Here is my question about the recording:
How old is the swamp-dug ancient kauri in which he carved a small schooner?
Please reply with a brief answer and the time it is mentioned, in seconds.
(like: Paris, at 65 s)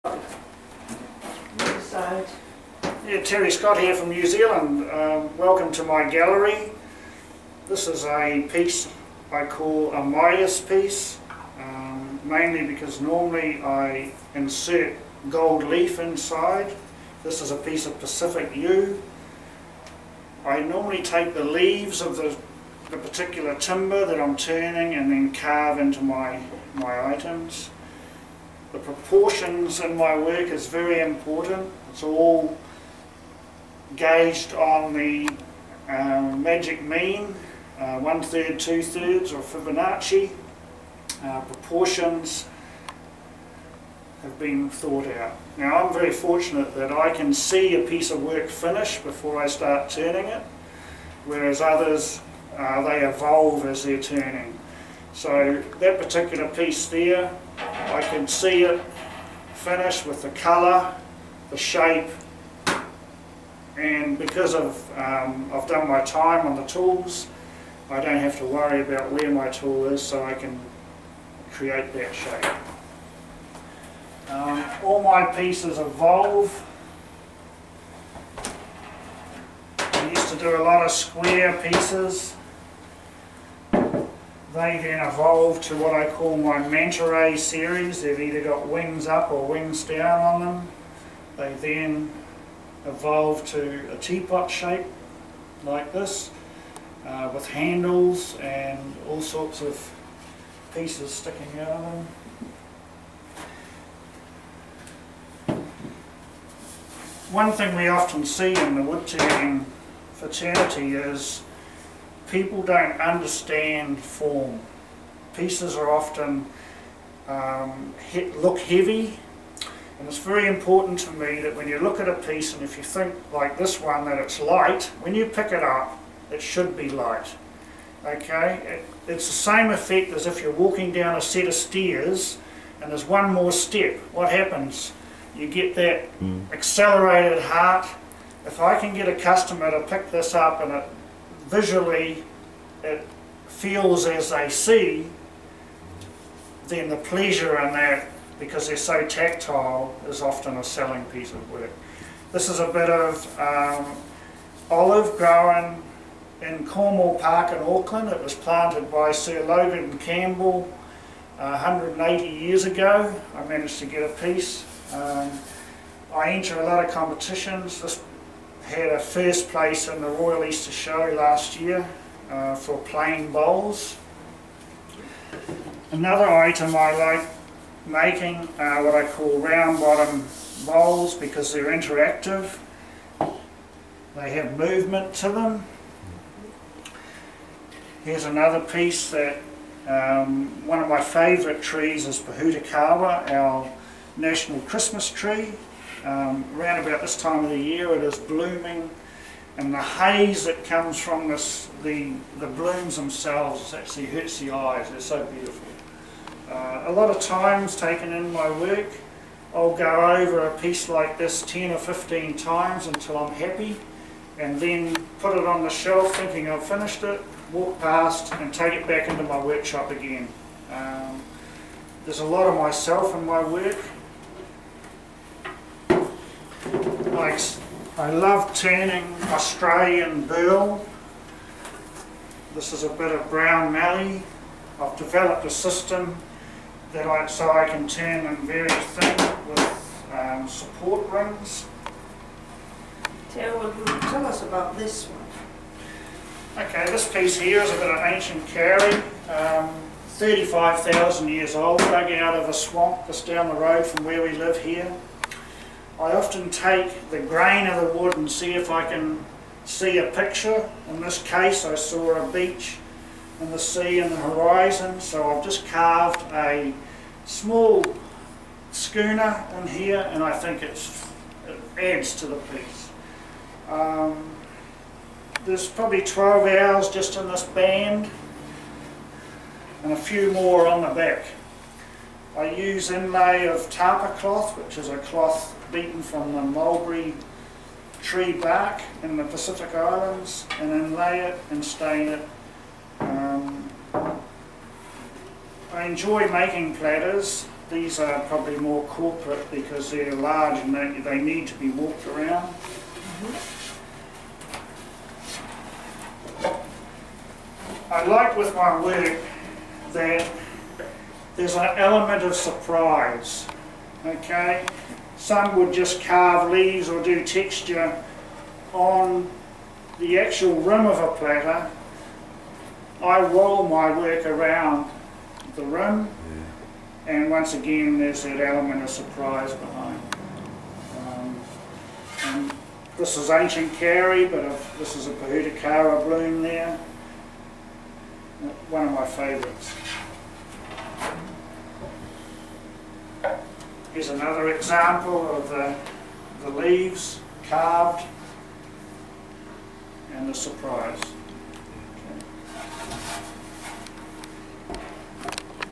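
35,000 years, at 250 s.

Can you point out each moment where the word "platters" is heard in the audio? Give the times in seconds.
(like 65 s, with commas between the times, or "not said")
296 s, 321 s.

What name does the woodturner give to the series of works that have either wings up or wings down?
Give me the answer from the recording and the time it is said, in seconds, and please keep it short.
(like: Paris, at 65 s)
manta ray series, at 86 s.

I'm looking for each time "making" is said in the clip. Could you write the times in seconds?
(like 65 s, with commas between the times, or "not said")
177 s, 296 s.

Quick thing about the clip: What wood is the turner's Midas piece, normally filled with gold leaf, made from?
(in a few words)
Pacific yew.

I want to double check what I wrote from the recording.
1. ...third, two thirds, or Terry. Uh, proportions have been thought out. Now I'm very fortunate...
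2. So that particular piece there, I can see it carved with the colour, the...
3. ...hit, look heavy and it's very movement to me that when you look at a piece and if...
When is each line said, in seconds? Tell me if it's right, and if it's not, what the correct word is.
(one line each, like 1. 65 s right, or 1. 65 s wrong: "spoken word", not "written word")
1. 38 s wrong: "Fibonacci", not "Terry"
2. 55 s wrong: "finished", not "carved"
3. 118 s wrong: "important", not "movement".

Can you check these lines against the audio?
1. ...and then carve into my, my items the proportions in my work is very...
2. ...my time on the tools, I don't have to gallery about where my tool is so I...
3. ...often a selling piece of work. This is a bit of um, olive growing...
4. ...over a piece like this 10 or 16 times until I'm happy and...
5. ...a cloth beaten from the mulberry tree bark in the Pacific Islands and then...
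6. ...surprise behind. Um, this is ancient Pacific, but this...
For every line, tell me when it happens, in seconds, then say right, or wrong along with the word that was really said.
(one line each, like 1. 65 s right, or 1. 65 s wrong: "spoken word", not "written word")
1. 24 s right
2. 65 s wrong: "worry", not "gallery"
3. 150 s right
4. 210 s wrong: "15", not "16"
5. 284 s right
6. 328 s wrong: "Kauri", not "Pacific".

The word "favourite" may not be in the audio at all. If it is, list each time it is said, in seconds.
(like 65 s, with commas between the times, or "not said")
191 s, 339 s.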